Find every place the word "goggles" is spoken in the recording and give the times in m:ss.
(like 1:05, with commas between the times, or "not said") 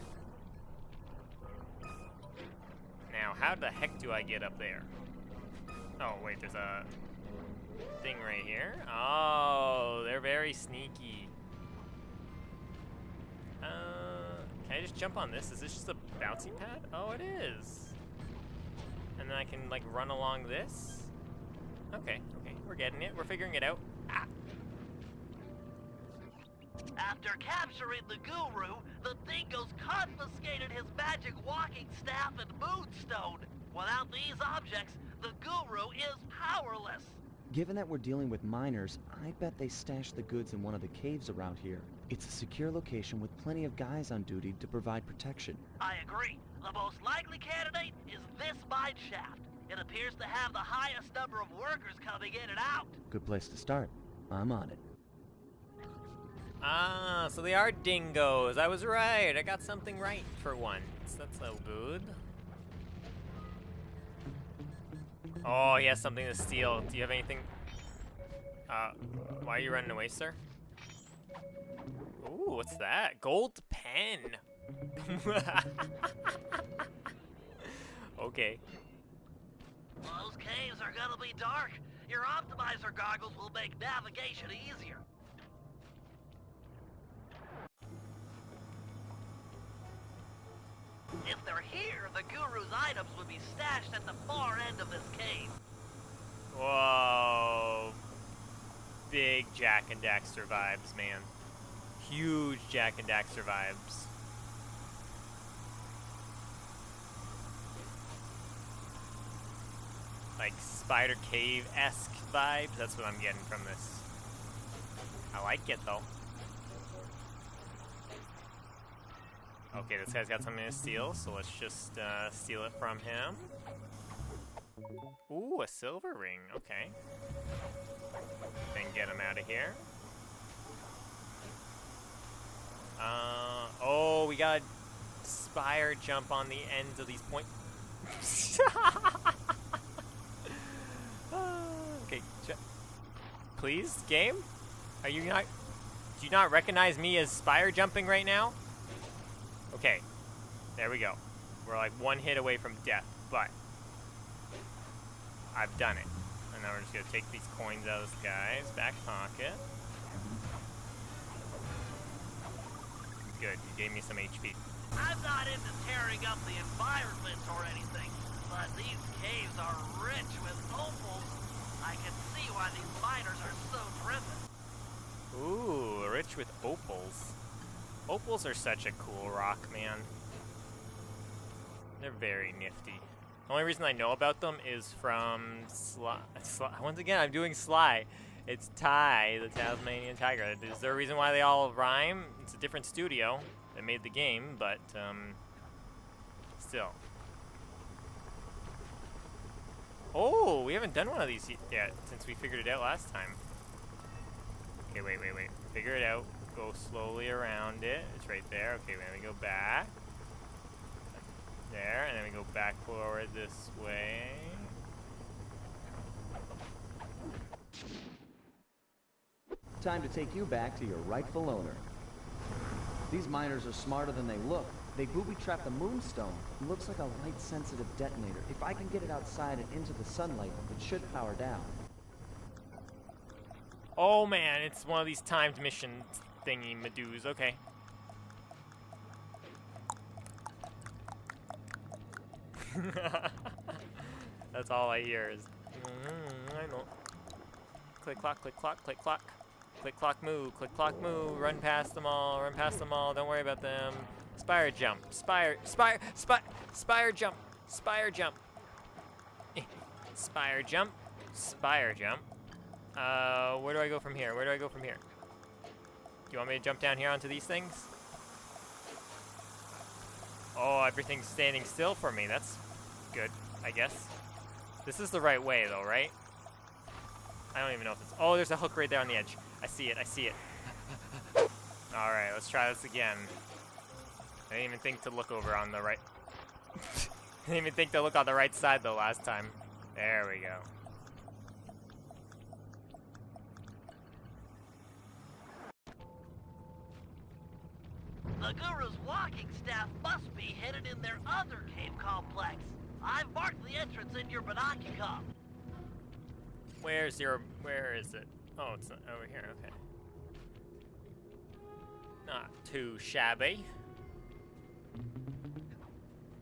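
1:22.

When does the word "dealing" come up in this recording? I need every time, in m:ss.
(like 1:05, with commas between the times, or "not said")
0:37.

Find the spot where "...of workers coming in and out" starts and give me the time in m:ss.
0:51.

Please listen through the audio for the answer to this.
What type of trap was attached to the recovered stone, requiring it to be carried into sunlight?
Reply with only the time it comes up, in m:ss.
3:47.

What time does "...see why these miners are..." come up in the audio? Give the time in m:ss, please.
2:52.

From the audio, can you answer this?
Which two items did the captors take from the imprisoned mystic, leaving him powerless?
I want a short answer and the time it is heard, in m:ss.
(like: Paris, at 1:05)
walking staff and moonstone, at 0:30.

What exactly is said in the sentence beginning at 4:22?
Uh, where do I go from here?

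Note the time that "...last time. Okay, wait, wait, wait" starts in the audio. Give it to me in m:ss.
3:22.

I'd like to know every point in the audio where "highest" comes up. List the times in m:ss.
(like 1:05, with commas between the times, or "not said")
0:50.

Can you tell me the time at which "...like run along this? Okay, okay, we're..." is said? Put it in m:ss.
0:19.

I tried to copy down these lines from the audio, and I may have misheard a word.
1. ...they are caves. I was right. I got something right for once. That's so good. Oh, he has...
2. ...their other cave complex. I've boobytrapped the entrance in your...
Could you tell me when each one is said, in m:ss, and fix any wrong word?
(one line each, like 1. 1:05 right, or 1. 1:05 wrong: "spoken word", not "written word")
1. 0:57 wrong: "dingoes", not "caves"
2. 5:00 wrong: "marked", not "boobytrapped".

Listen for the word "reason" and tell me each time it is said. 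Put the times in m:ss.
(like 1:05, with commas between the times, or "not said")
3:03, 3:10.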